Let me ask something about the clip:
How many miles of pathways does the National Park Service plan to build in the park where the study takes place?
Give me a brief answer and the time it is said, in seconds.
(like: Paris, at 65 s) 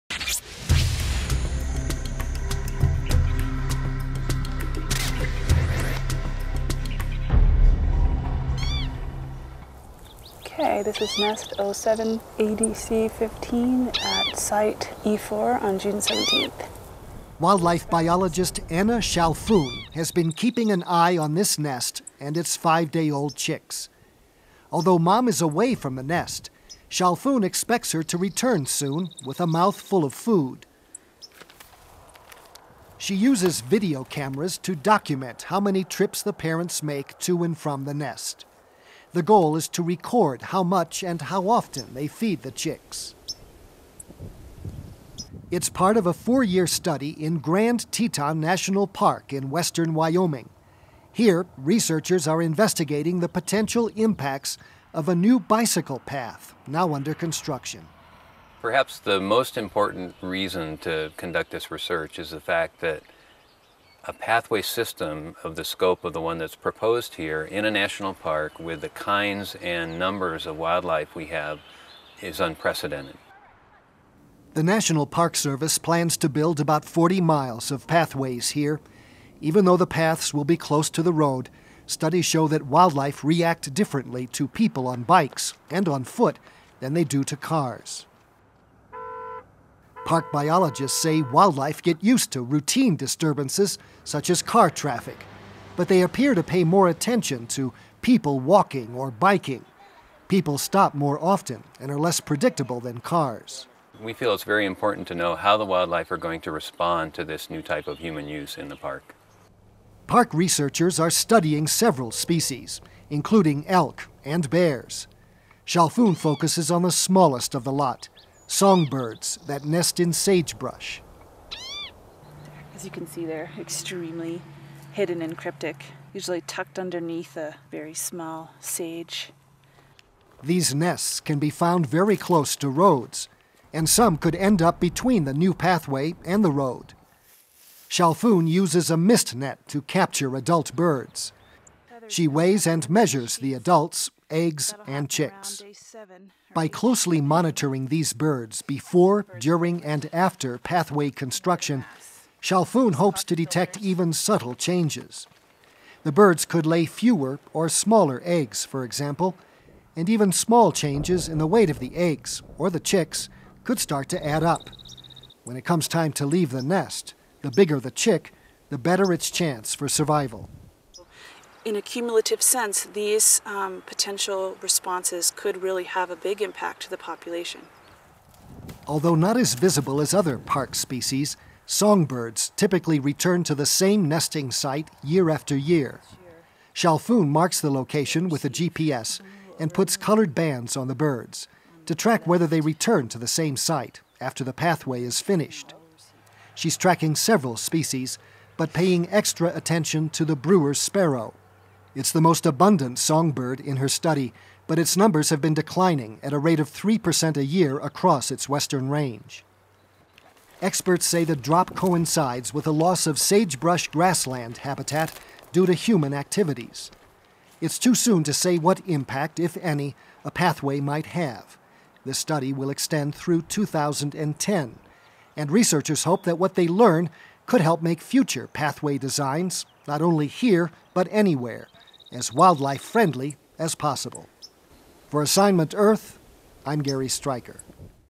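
40, at 76 s.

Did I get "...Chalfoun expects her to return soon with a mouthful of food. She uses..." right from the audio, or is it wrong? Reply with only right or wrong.
right.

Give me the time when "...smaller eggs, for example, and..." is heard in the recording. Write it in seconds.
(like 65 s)
157 s.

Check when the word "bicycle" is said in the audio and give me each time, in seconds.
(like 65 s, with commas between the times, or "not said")
55 s.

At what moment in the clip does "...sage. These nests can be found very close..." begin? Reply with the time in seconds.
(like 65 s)
128 s.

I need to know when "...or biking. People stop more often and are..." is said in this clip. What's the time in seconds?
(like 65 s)
98 s.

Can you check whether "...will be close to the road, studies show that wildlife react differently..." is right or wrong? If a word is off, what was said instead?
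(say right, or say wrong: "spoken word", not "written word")
right.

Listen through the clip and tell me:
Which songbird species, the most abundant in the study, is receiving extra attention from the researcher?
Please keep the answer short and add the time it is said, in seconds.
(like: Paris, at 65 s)
Brewer's sparrow, at 200 s.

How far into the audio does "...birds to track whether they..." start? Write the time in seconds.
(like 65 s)
190 s.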